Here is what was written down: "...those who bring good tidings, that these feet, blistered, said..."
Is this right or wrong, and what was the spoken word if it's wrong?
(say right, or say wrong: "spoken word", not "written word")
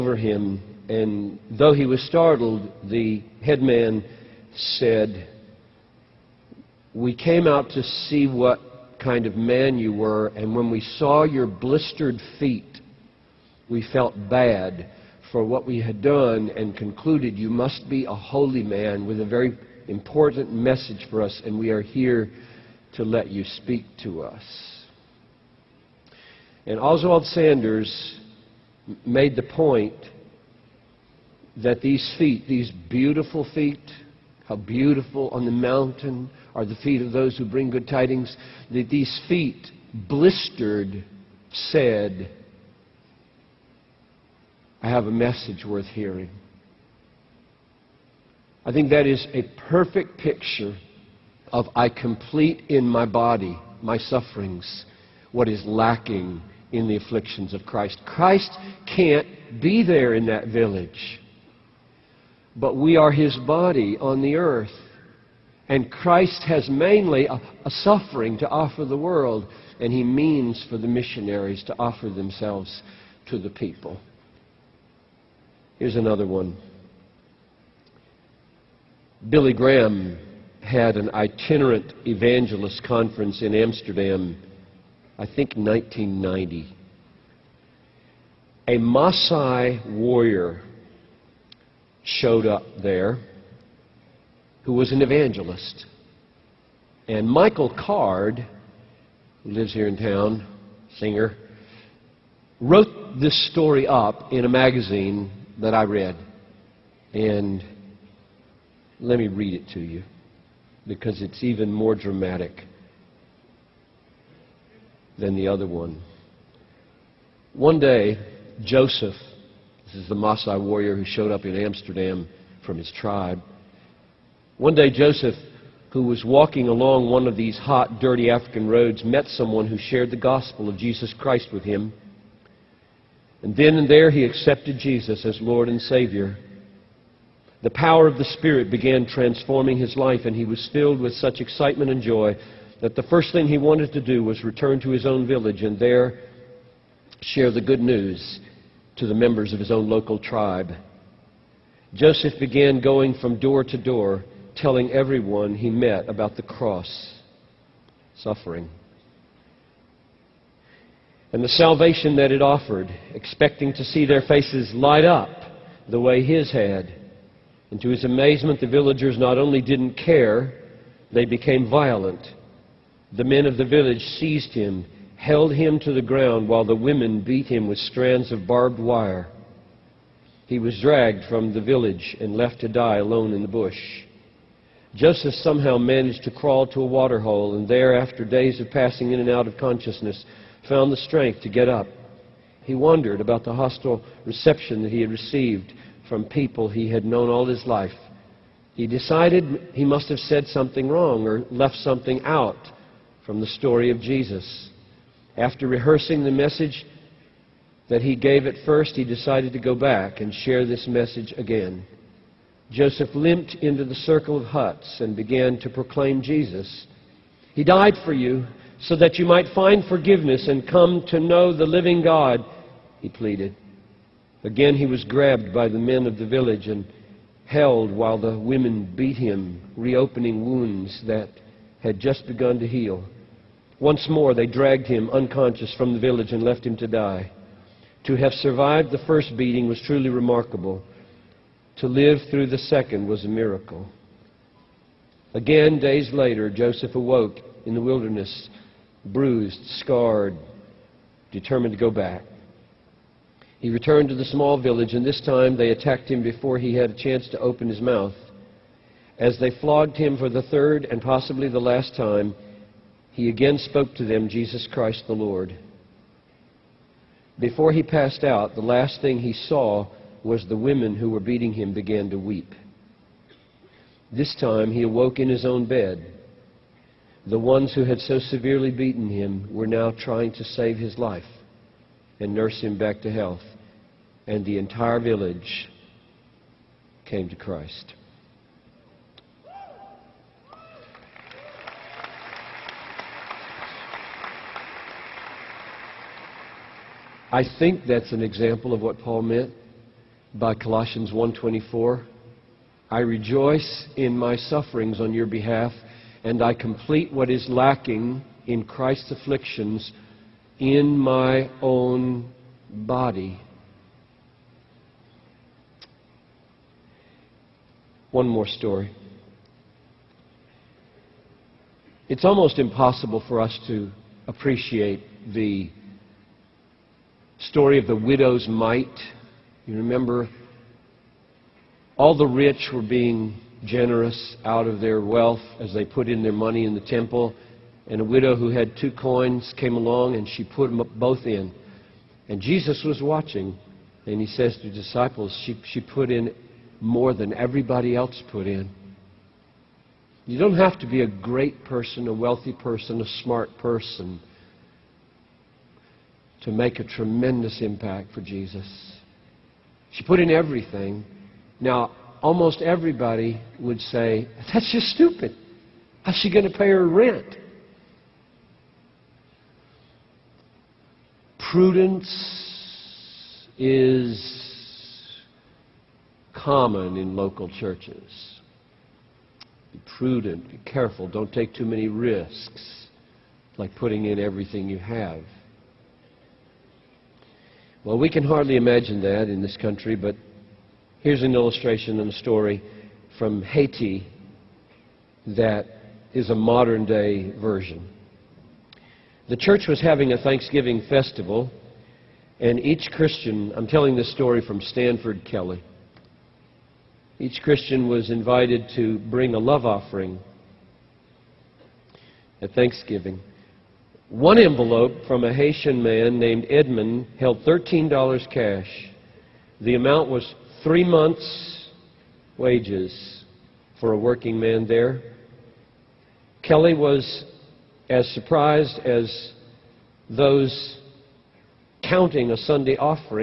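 right.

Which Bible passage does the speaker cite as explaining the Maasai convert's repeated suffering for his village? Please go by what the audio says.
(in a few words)
Colossians 1:24.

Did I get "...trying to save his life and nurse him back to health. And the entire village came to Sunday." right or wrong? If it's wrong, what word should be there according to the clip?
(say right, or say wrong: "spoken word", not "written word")
wrong: "Christ", not "Sunday".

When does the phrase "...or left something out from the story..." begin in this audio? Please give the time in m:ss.
3:21.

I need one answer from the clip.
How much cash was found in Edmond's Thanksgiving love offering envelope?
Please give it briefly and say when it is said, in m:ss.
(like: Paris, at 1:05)
$13, at 6:57.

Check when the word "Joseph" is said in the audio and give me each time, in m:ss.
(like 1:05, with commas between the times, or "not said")
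1:58, 2:04, 2:31, 3:04, 3:32, 4:06.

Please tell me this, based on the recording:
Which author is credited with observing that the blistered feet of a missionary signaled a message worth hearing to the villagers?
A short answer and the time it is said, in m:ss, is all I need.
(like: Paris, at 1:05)
Oswald Sanders, at 0:26.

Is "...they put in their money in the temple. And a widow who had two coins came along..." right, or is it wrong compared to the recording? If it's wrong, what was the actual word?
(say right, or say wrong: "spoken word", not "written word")
right.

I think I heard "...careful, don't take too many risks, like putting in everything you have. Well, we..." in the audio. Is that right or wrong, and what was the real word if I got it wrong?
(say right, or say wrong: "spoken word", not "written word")
right.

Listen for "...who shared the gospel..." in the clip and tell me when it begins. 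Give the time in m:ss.
2:09.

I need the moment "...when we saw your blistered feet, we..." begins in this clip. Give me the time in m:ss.
0:10.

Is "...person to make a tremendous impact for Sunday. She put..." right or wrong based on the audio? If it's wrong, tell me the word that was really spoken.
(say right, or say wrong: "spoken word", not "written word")
wrong: "Jesus", not "Sunday".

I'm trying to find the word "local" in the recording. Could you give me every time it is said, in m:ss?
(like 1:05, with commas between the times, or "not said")
2:29, 6:17.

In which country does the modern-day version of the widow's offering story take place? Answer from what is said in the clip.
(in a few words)
Haiti.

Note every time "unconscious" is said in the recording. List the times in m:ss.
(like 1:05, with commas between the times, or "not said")
3:55.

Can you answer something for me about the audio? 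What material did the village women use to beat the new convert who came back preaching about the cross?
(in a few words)
barbed wire.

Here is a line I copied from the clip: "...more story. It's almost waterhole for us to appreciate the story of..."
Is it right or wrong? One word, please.
wrong.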